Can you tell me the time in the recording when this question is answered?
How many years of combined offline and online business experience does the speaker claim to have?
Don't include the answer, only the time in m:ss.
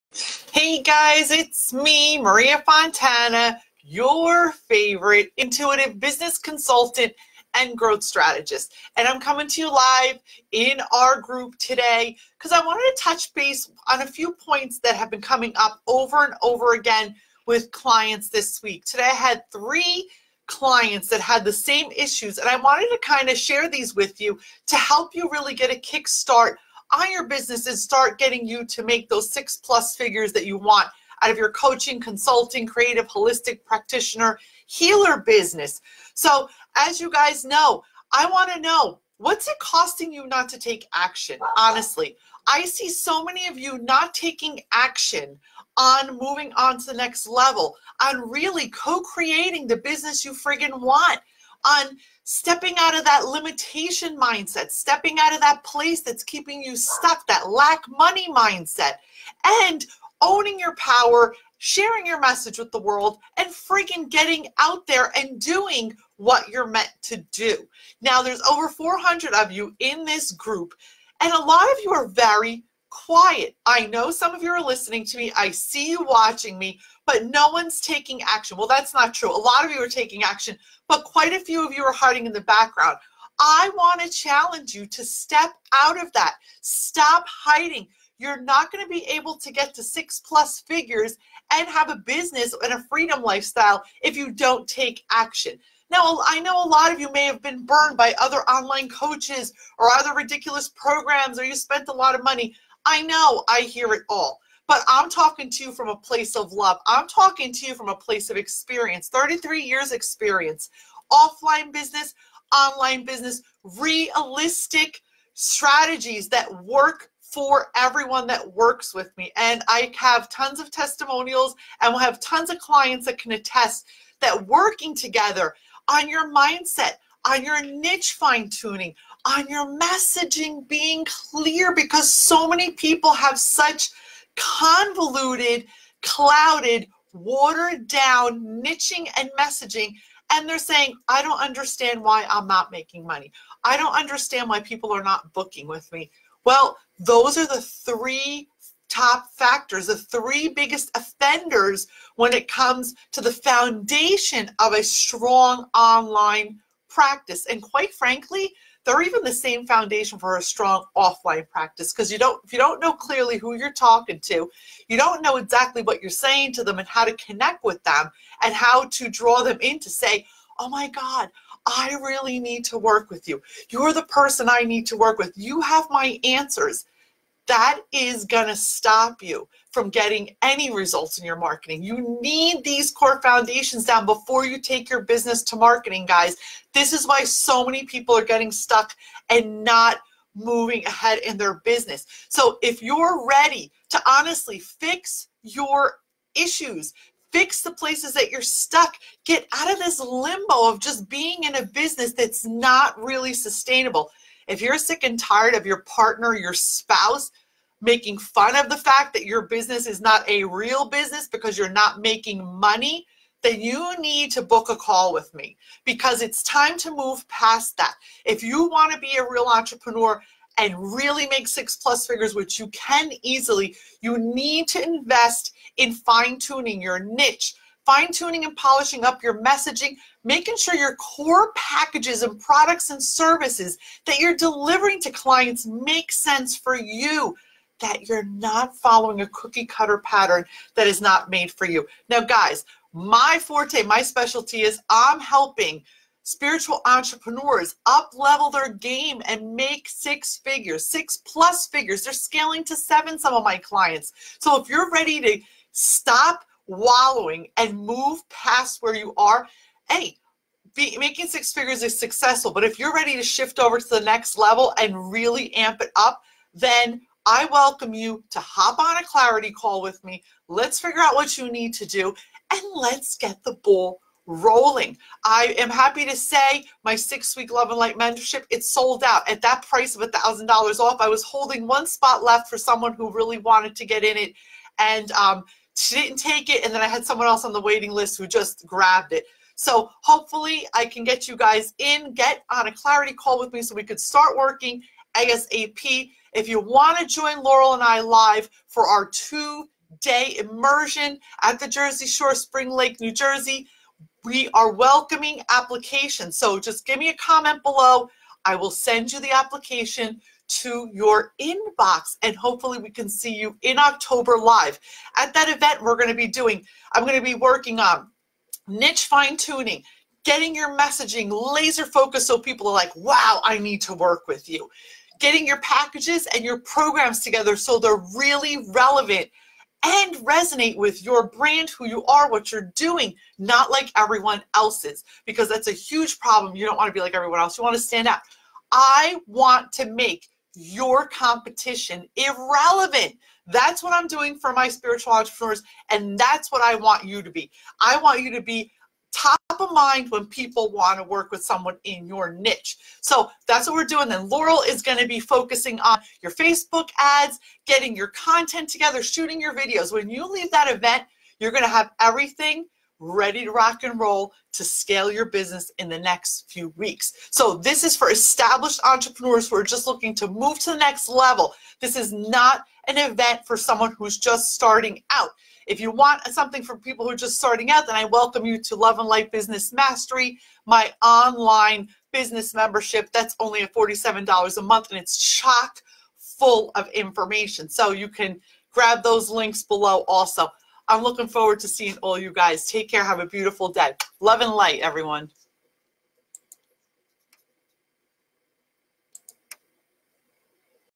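1:49.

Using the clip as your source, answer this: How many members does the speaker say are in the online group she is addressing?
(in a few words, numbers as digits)
over 400.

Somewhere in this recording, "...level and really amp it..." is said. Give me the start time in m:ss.
4:24.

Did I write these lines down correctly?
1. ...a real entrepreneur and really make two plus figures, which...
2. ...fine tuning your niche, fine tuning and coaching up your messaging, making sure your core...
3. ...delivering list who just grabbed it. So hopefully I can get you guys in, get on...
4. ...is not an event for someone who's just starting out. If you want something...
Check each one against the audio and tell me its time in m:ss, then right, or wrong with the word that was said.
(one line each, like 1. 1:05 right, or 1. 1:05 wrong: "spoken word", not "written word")
1. 3:39 wrong: "six", not "two"
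2. 3:45 wrong: "polishing", not "coaching"
3. 4:47 wrong: "waiting", not "delivering"
4. 6:11 right.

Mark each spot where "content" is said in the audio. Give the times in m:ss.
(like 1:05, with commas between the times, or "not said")
5:58.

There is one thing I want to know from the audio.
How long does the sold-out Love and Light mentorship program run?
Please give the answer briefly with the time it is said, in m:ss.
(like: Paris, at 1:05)
6 weeks, at 4:36.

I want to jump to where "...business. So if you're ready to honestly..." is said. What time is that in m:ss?
3:11.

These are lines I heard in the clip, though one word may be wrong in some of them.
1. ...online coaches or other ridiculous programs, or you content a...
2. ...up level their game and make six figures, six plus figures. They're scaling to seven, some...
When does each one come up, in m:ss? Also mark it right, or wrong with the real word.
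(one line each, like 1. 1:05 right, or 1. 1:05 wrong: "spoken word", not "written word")
1. 1:38 wrong: "spent", not "content"
2. 4:07 right.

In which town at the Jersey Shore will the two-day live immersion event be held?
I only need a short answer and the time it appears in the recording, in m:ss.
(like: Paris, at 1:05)
Spring Lake, at 5:02.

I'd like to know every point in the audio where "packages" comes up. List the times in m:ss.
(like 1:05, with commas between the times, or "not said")
3:51, 5:25.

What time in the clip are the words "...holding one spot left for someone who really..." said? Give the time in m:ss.
4:41.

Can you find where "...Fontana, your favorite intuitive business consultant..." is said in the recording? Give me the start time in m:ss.
0:02.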